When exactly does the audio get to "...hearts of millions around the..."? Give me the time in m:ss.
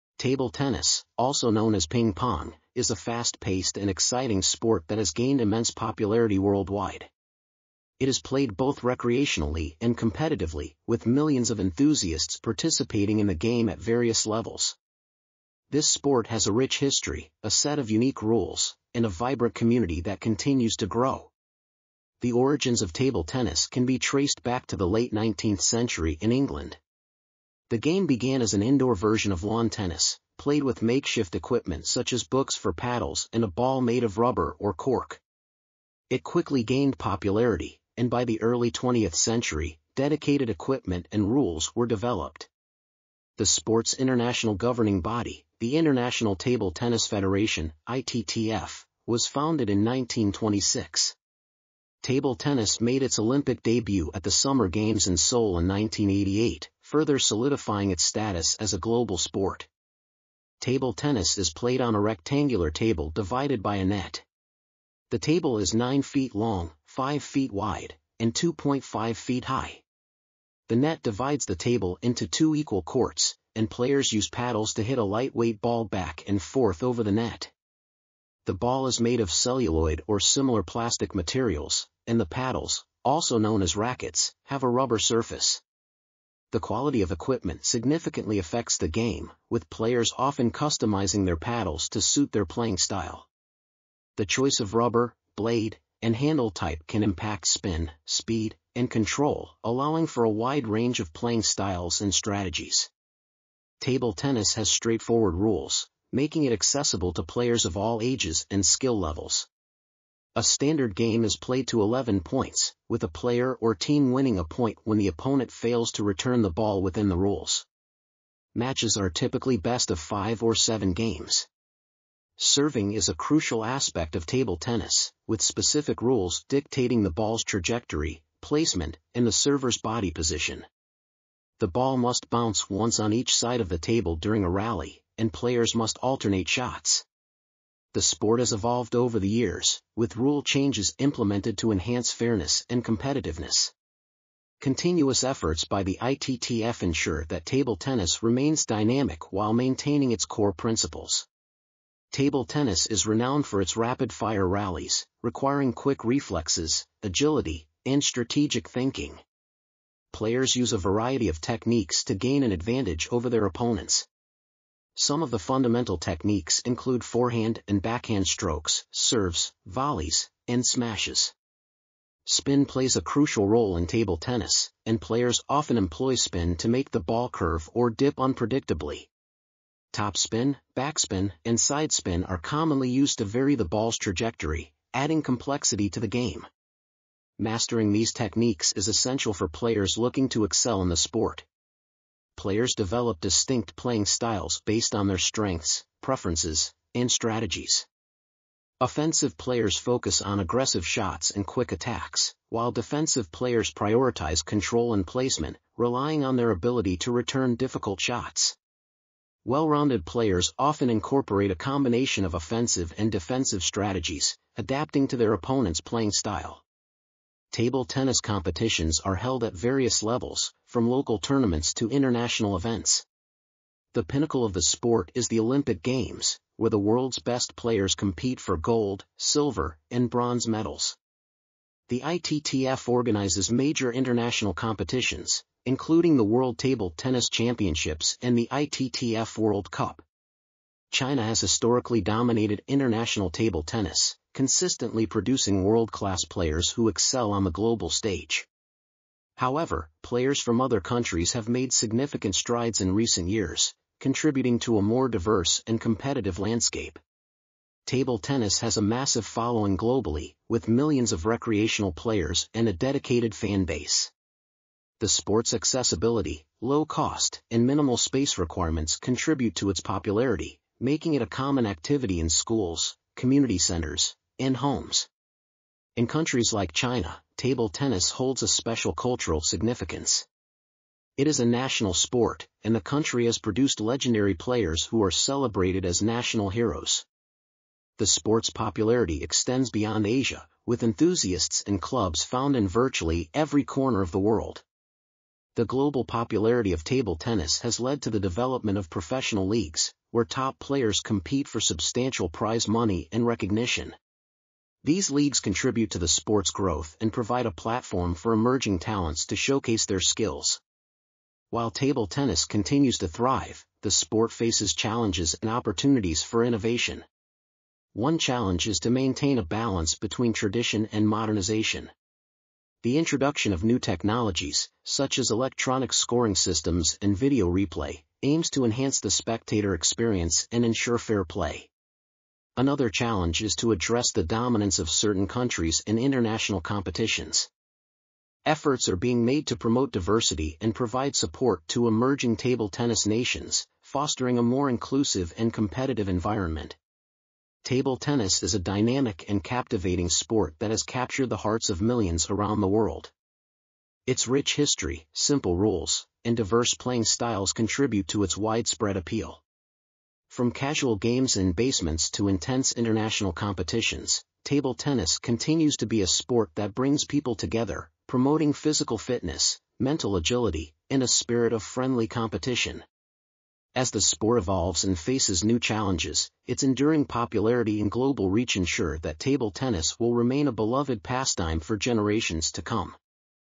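5:51.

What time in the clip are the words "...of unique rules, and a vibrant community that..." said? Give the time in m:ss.
0:17.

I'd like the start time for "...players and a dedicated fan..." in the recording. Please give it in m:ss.
4:21.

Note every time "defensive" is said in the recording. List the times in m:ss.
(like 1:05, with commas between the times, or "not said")
3:22, 3:33.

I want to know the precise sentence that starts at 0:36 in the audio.
It quickly gained popularity, and by the early 20th century, dedicated equipment and rules were developed.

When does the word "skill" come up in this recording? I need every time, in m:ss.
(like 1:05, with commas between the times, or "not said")
1:48, 5:09.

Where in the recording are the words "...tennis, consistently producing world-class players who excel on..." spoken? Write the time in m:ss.
4:03.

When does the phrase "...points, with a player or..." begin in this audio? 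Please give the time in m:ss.
1:52.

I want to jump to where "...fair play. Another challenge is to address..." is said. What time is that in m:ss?
5:30.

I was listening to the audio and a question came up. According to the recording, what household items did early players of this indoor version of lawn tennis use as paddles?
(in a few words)
books.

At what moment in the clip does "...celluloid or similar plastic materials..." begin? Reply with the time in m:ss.
1:19.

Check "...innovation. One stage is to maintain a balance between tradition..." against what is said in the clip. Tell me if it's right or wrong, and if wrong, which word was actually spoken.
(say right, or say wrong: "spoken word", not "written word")
wrong: "challenge", not "stage".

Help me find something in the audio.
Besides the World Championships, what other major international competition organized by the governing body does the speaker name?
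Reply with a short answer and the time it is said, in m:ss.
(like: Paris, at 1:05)
ITTF World Cup, at 3:58.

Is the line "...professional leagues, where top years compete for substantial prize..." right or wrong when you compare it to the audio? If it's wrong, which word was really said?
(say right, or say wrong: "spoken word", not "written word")
wrong: "players", not "years".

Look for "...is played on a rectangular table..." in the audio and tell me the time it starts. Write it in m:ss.
1:01.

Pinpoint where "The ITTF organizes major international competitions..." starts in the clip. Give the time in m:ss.
3:51.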